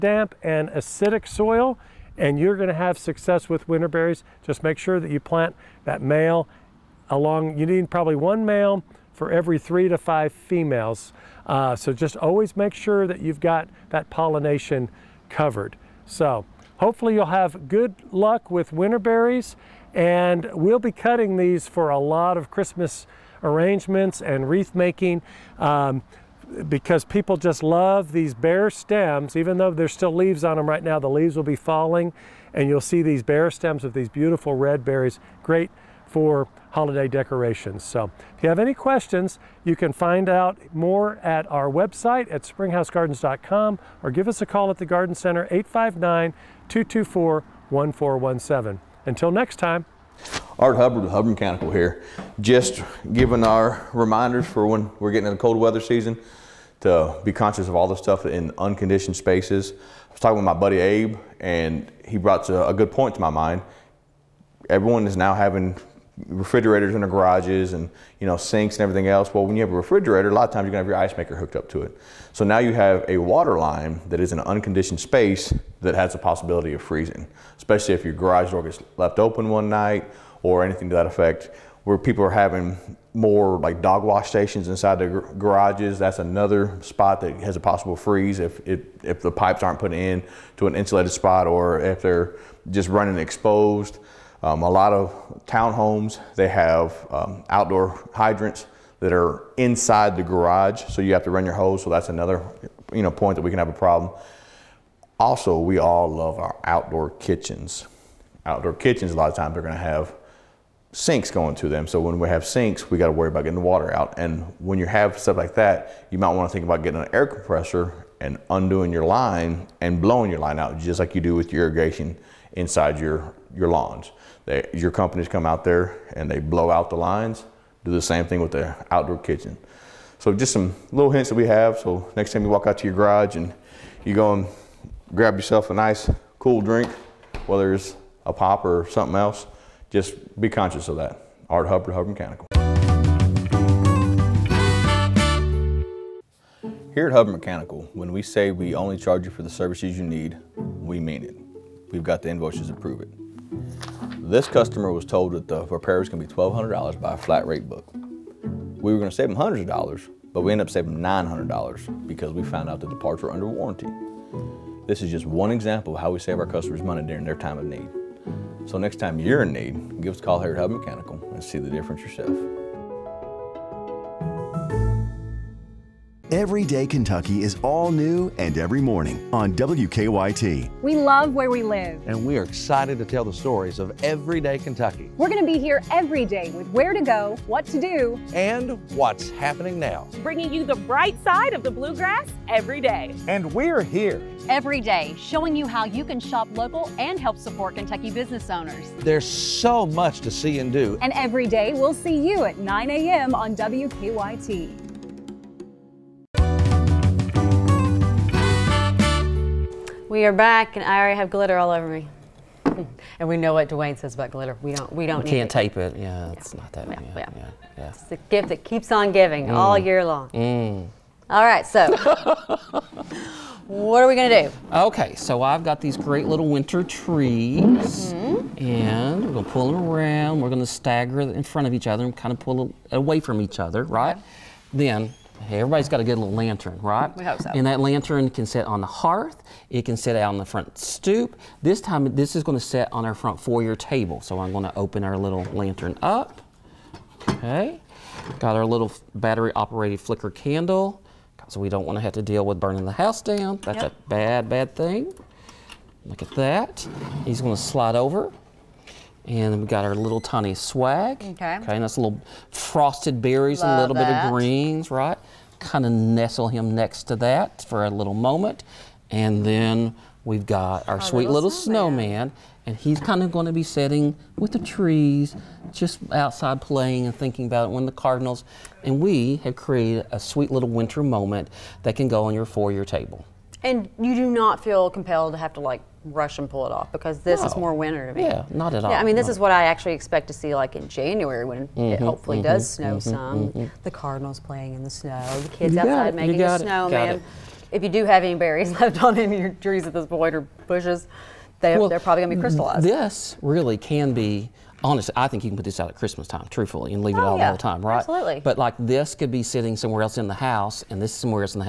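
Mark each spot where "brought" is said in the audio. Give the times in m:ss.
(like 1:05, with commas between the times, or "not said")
1:02.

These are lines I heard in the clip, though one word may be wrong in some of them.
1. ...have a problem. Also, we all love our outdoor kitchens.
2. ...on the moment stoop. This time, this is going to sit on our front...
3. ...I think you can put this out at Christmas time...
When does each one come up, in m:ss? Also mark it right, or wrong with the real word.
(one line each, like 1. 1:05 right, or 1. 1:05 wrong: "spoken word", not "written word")
1. 1:43 right
2. 4:00 wrong: "front", not "moment"
3. 5:05 right.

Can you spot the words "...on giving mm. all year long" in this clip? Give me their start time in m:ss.
3:38.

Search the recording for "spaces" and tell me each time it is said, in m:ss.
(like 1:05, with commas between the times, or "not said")
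0:59, 1:14.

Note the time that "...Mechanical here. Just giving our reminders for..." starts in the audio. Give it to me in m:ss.
0:51.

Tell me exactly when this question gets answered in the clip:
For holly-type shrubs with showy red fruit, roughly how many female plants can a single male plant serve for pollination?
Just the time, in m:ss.
0:09.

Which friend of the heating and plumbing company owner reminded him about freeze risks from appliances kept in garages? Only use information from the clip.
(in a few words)
Abe.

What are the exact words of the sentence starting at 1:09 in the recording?
Well, when you have a refrigerator, a lot of times you're gonna have your ice maker hooked up to it.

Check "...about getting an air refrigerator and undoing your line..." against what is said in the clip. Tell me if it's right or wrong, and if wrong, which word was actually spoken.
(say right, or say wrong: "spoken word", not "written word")
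wrong: "compressor", not "refrigerator".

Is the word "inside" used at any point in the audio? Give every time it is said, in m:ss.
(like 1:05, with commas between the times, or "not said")
1:24, 1:39, 2:02.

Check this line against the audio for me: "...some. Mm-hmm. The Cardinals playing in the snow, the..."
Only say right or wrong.
right.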